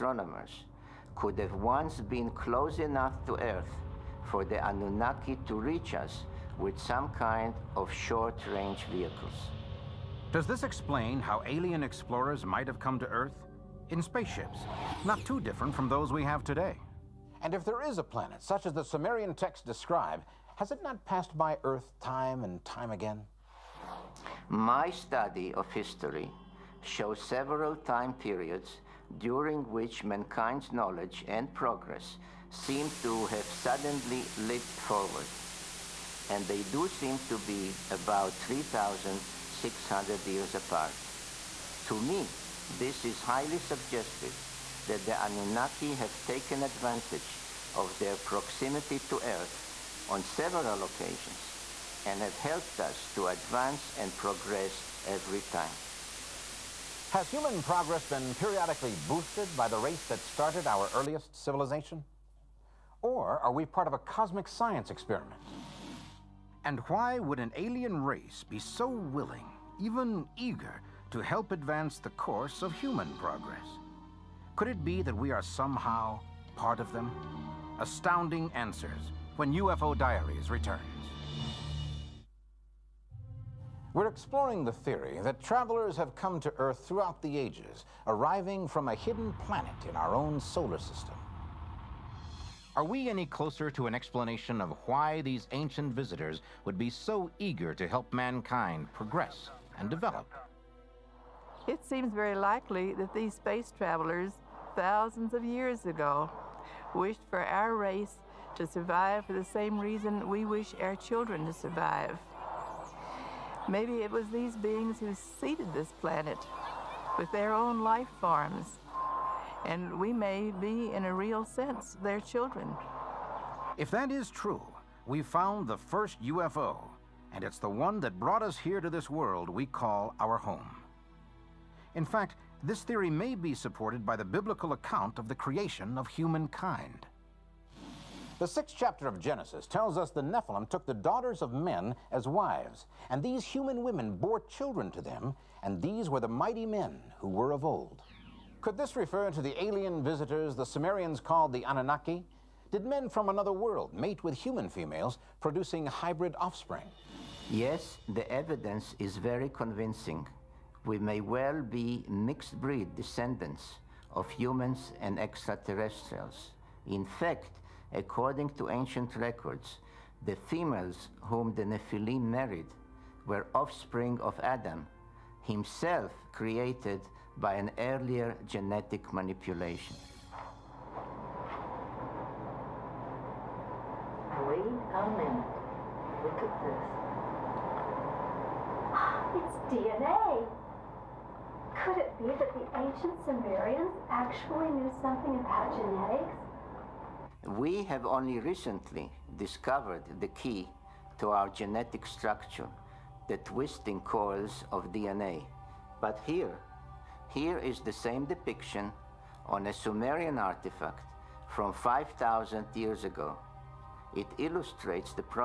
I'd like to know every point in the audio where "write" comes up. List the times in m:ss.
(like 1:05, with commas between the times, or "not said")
not said.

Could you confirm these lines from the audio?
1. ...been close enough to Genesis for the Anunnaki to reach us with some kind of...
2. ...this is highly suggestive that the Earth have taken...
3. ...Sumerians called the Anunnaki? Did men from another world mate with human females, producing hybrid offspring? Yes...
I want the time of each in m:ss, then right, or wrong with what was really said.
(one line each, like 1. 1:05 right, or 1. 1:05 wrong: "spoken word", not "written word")
1. 0:01 wrong: "Earth", not "Genesis"
2. 0:42 wrong: "Anunnaki", not "Earth"
3. 2:30 right.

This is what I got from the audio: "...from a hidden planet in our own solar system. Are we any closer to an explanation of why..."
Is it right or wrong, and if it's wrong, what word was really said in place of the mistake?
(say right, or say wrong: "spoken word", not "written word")
right.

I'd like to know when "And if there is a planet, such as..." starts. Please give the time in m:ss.
0:17.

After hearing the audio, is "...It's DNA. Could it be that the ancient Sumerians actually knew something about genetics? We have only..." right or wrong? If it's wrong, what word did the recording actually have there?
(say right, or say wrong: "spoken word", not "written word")
right.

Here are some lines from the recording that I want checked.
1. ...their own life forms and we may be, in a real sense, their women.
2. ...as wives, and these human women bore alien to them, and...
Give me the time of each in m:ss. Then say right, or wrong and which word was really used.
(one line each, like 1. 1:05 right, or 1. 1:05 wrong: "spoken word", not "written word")
1. 1:57 wrong: "children", not "women"
2. 2:22 wrong: "children", not "alien".